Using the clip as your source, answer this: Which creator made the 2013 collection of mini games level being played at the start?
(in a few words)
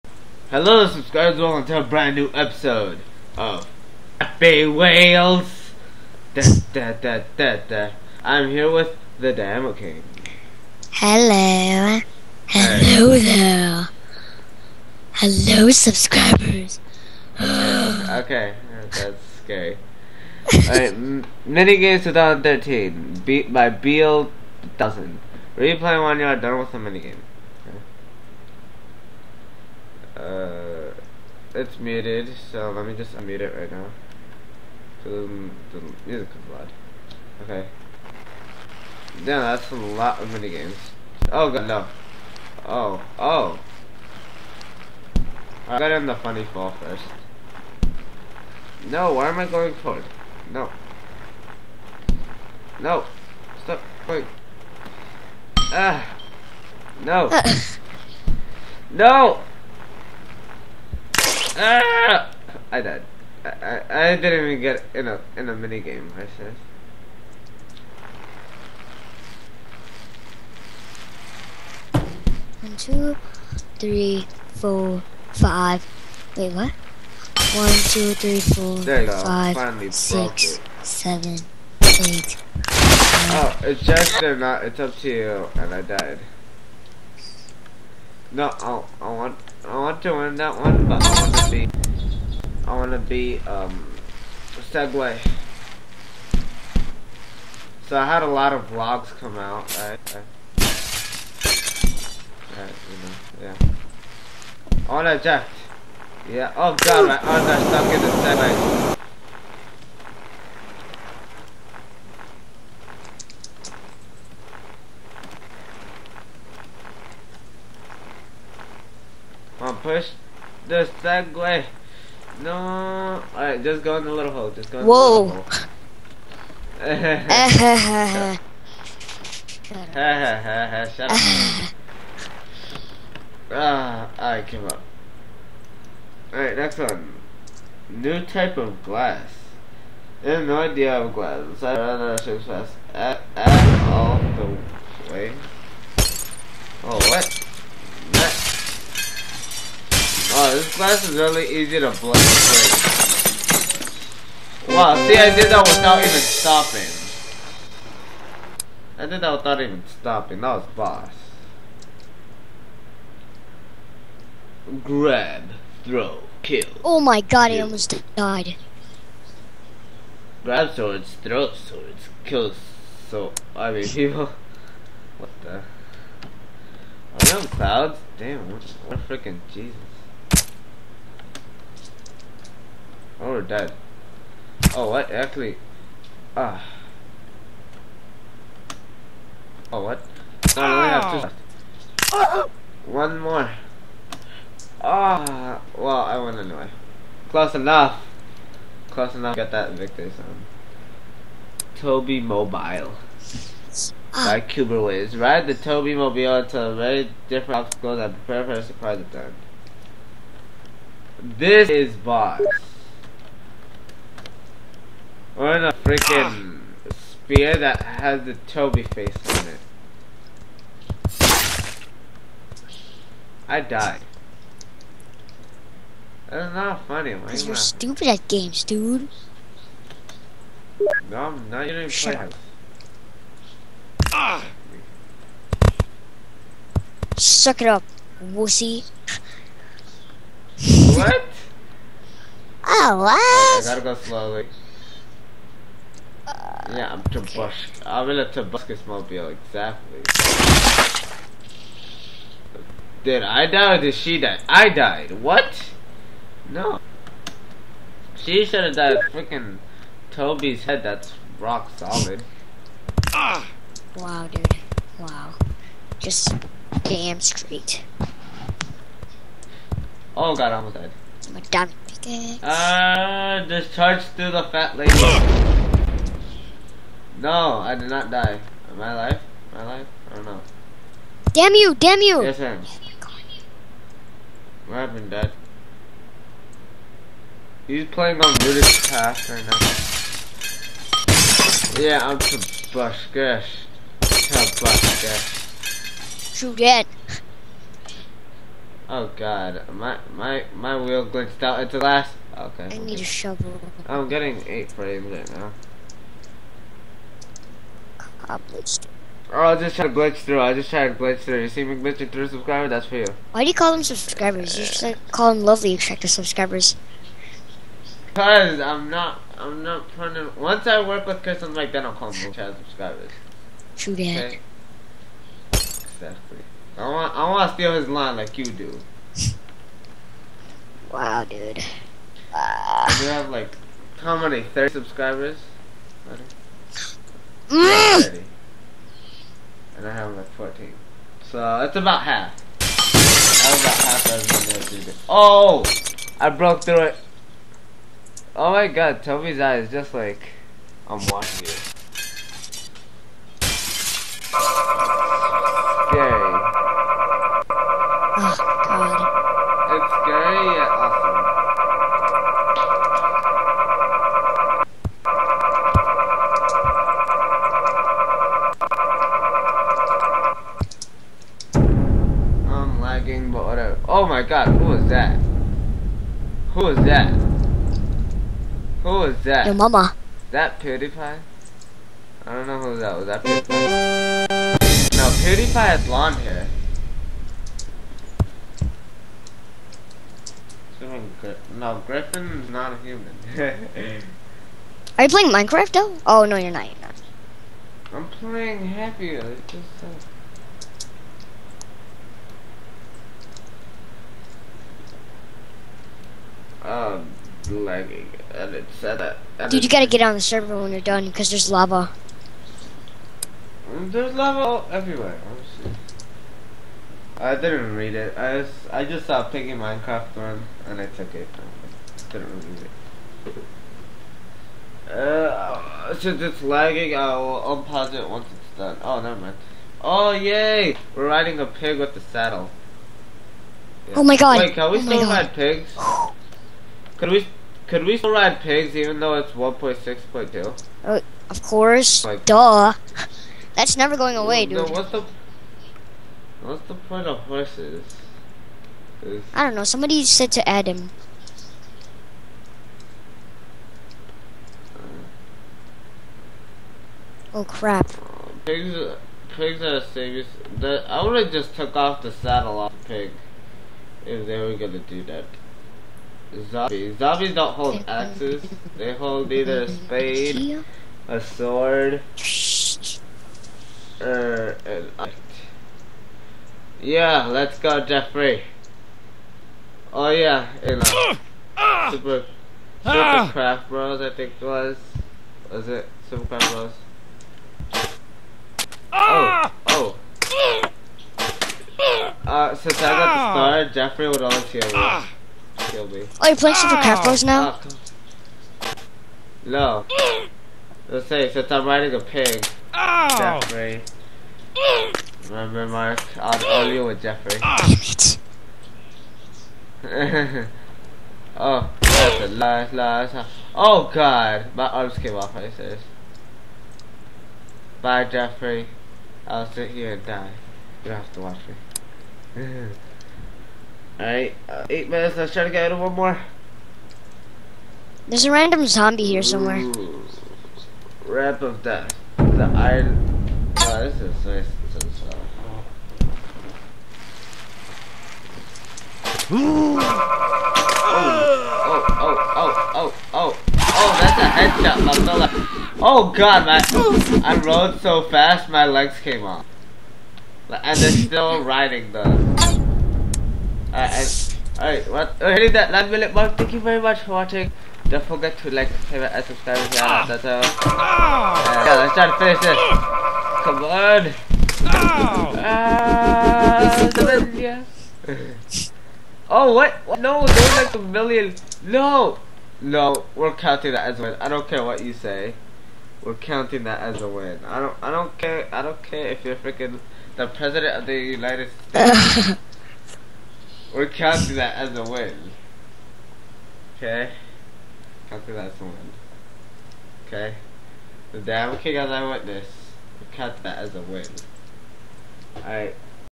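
Beal 1000.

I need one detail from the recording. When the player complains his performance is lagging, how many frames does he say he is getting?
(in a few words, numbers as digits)
8.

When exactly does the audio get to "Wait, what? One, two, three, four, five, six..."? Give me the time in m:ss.
1:16.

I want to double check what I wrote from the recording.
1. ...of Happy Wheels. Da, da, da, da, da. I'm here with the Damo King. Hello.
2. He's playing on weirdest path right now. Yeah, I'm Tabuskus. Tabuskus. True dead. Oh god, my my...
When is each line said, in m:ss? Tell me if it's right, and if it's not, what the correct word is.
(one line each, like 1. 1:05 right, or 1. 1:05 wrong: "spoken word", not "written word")
1. 0:03 right
2. 4:47 right.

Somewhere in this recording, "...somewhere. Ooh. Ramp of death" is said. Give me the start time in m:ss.
8:49.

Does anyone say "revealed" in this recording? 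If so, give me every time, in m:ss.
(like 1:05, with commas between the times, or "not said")
not said.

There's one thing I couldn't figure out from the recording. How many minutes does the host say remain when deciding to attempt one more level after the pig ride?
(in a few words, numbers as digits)
8.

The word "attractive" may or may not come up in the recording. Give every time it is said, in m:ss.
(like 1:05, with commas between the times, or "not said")
5:15, 5:22.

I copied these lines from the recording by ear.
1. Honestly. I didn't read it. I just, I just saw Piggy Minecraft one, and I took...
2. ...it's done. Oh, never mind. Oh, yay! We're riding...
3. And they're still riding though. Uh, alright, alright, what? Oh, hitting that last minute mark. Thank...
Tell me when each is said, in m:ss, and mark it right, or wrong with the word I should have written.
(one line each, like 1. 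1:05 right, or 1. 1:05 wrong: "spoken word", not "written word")
1. 6:55 right
2. 7:08 right
3. 9:10 right.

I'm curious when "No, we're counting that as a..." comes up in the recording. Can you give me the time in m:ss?
9:32.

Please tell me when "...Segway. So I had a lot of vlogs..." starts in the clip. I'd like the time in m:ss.
1:34.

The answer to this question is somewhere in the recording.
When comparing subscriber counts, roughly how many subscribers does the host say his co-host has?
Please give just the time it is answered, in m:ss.
5:34.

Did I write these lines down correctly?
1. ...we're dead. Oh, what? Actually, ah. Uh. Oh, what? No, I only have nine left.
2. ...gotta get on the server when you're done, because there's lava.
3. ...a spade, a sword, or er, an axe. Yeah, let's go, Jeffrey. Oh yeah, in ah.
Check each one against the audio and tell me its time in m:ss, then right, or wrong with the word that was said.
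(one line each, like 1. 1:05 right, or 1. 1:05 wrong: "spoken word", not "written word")
1. 3:03 wrong: "two", not "nine"
2. 6:49 right
3. 7:49 right.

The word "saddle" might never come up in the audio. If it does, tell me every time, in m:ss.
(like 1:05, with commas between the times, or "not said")
7:12, 7:42.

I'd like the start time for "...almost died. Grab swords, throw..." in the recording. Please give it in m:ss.
2:47.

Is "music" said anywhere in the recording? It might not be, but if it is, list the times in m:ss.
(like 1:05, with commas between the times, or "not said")
0:36.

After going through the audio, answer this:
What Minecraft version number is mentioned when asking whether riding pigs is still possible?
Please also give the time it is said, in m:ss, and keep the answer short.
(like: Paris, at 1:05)
1.6.2, at 7:19.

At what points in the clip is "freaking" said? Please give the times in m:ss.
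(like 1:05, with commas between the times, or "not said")
2:59, 3:35, 4:19, 9:39.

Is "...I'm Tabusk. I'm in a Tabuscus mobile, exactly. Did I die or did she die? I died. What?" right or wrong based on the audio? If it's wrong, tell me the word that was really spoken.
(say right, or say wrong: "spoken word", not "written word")
right.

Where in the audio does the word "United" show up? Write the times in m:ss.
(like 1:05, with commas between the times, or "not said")
9:40.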